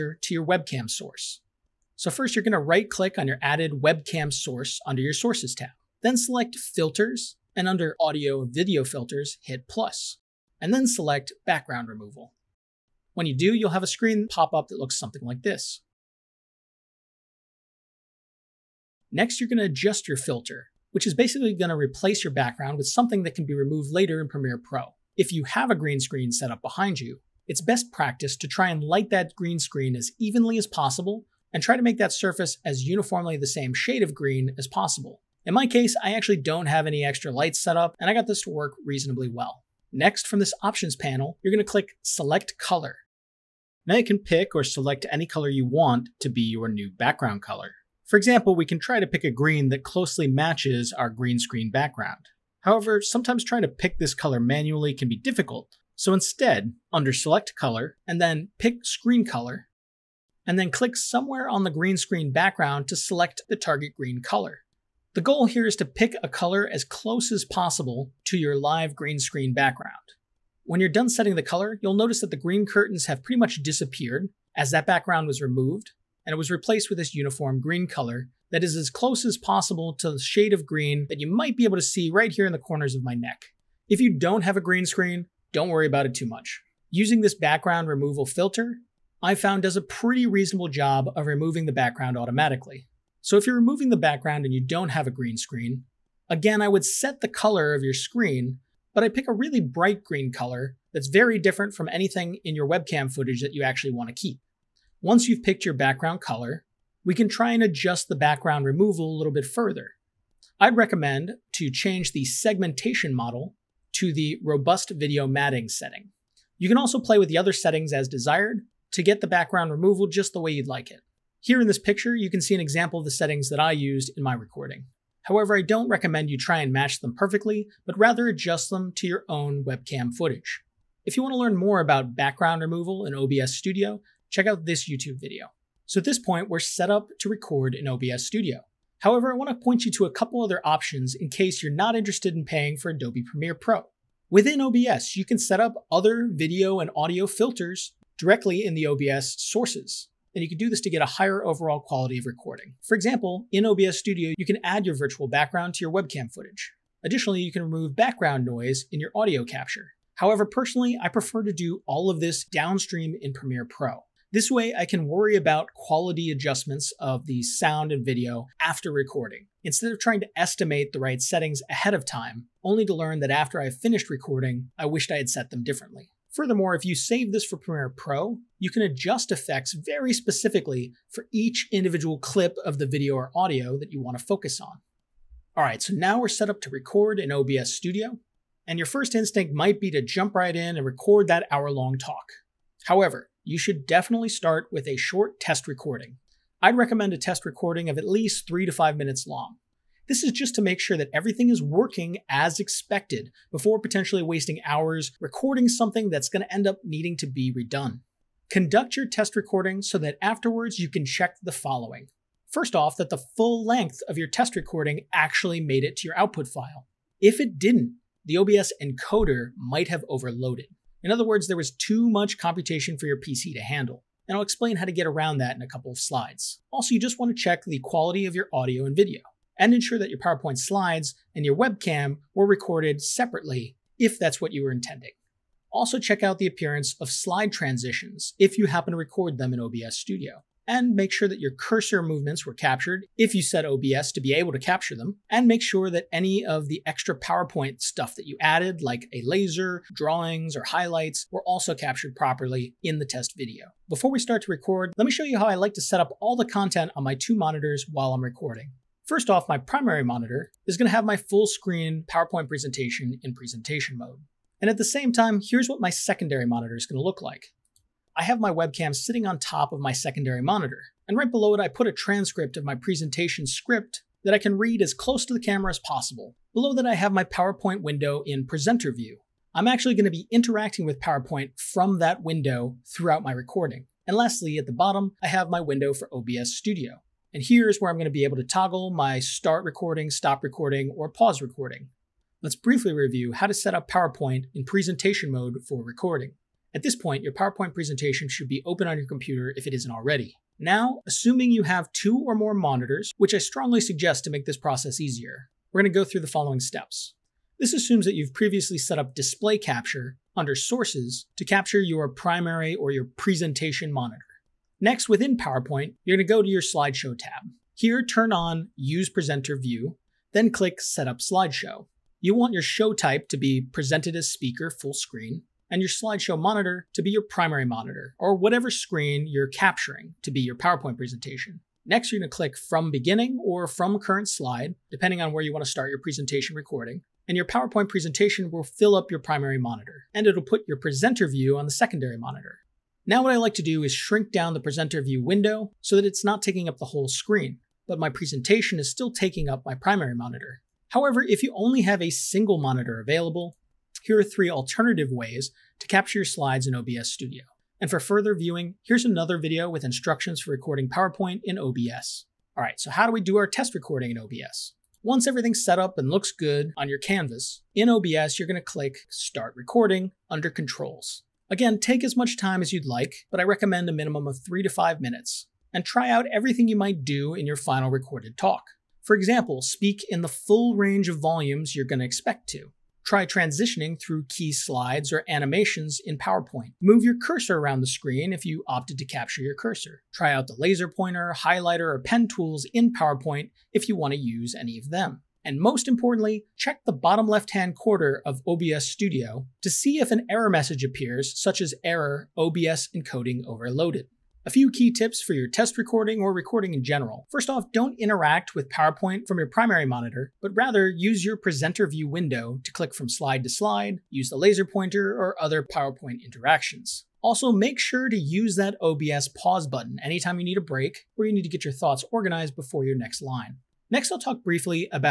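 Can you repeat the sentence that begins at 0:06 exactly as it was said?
Then select filters and under audio and video filters, hit And then select background removal.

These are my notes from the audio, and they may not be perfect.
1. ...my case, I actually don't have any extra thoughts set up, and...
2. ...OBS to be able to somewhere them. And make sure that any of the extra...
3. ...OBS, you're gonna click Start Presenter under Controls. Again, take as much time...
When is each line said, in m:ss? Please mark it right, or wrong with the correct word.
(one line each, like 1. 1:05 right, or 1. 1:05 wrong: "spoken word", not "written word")
1. 0:35 wrong: "lights", not "thoughts"
2. 4:03 wrong: "capture", not "somewhere"
3. 6:07 wrong: "Recording", not "Presenter".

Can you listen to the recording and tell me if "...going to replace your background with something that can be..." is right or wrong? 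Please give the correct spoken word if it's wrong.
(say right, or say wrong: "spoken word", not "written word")
right.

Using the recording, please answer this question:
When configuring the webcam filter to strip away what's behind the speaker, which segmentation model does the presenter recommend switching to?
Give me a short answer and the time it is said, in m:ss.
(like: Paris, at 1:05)
Robust video matting, at 1:54.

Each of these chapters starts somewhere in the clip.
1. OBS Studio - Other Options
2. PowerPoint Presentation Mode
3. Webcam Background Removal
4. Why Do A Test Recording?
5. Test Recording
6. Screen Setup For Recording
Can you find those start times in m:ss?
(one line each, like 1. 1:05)
1. 2:15
2. 4:51
3. 0:18
4. 3:04
5. 6:02
6. 4:13.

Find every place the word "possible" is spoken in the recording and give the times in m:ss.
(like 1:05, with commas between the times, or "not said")
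0:30, 0:34, 1:07, 1:19, 4:35.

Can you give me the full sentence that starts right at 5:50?
However, if you only have a single monitor available, here are three alternative ways to capture your slides in OBS Studio.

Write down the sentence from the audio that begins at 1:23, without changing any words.
If you don't have a green screen, don't worry about it too much.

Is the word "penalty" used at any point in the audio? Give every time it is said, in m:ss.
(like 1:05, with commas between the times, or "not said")
not said.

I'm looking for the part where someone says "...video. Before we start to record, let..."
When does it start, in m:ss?
4:13.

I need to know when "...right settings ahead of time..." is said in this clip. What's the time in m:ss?
2:51.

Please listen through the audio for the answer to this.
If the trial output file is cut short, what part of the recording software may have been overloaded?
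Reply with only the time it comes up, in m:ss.
3:38.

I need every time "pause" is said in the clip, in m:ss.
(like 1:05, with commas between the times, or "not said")
4:51, 6:59.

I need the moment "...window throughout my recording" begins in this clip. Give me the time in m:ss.
4:42.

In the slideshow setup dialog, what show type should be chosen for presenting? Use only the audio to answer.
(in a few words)
Speaker full screen.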